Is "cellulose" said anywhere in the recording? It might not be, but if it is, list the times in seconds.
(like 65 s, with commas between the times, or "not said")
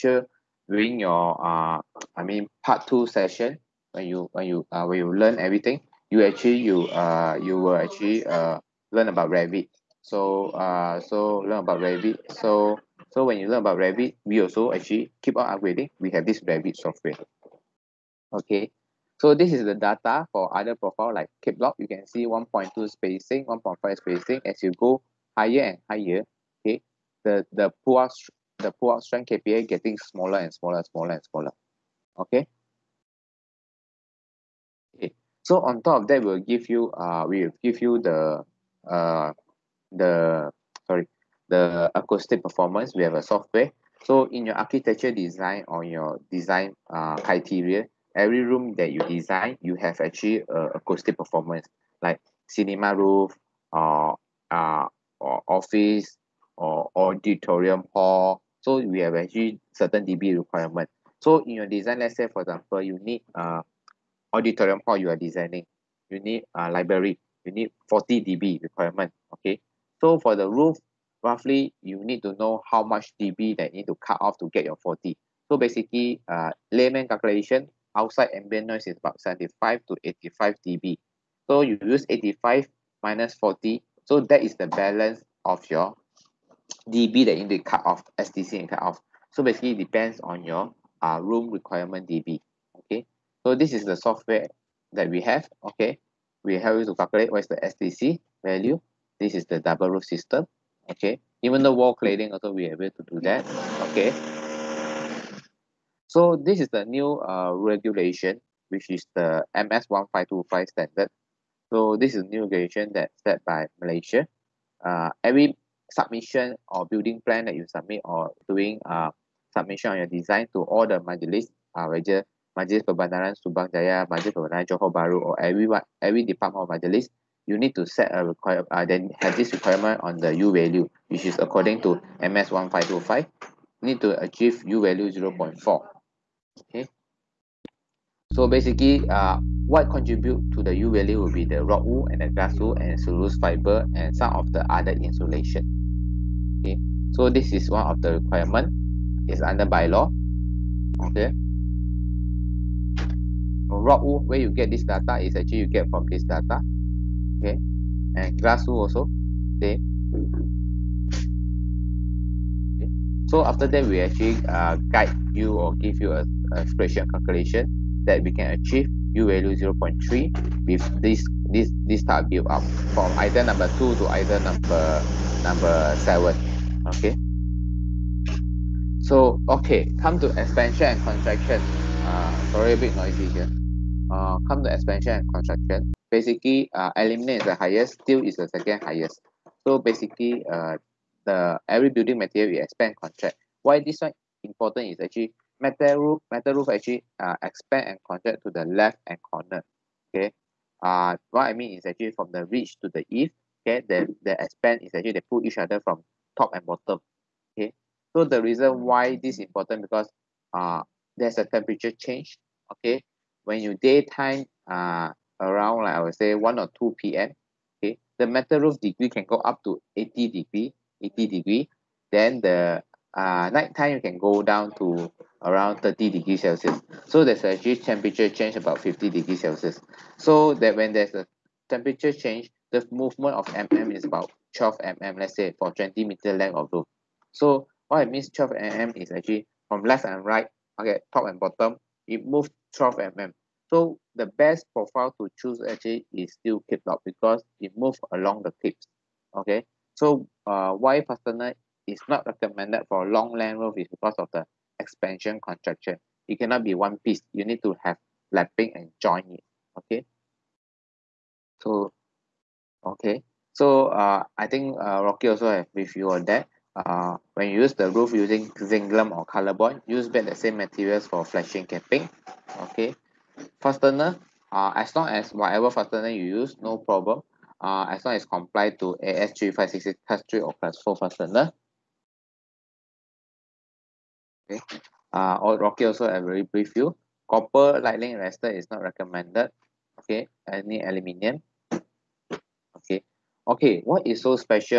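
142 s.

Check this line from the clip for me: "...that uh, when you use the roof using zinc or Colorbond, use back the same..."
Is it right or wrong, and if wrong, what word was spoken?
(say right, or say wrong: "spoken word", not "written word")
right.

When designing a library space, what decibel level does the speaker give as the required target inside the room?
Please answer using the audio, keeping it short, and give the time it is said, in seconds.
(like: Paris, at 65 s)
40 dB, at 67 s.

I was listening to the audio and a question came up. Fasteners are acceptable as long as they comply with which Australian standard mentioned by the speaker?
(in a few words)
AS3566.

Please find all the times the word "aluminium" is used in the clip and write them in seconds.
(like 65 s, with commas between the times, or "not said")
186 s, 290 s.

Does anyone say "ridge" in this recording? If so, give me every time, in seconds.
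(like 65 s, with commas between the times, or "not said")
202 s.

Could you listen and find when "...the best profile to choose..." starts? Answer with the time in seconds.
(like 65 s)
244 s.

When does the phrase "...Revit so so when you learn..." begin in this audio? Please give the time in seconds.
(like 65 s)
11 s.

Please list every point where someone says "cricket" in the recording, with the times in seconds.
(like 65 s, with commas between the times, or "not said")
not said.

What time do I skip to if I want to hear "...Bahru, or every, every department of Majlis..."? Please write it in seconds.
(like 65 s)
124 s.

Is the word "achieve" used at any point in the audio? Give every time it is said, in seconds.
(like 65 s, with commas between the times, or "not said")
134 s, 168 s.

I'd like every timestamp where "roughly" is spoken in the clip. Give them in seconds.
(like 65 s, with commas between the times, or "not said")
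71 s.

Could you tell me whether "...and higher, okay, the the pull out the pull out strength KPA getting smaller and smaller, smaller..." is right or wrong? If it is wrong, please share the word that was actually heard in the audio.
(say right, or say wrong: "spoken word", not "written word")
right.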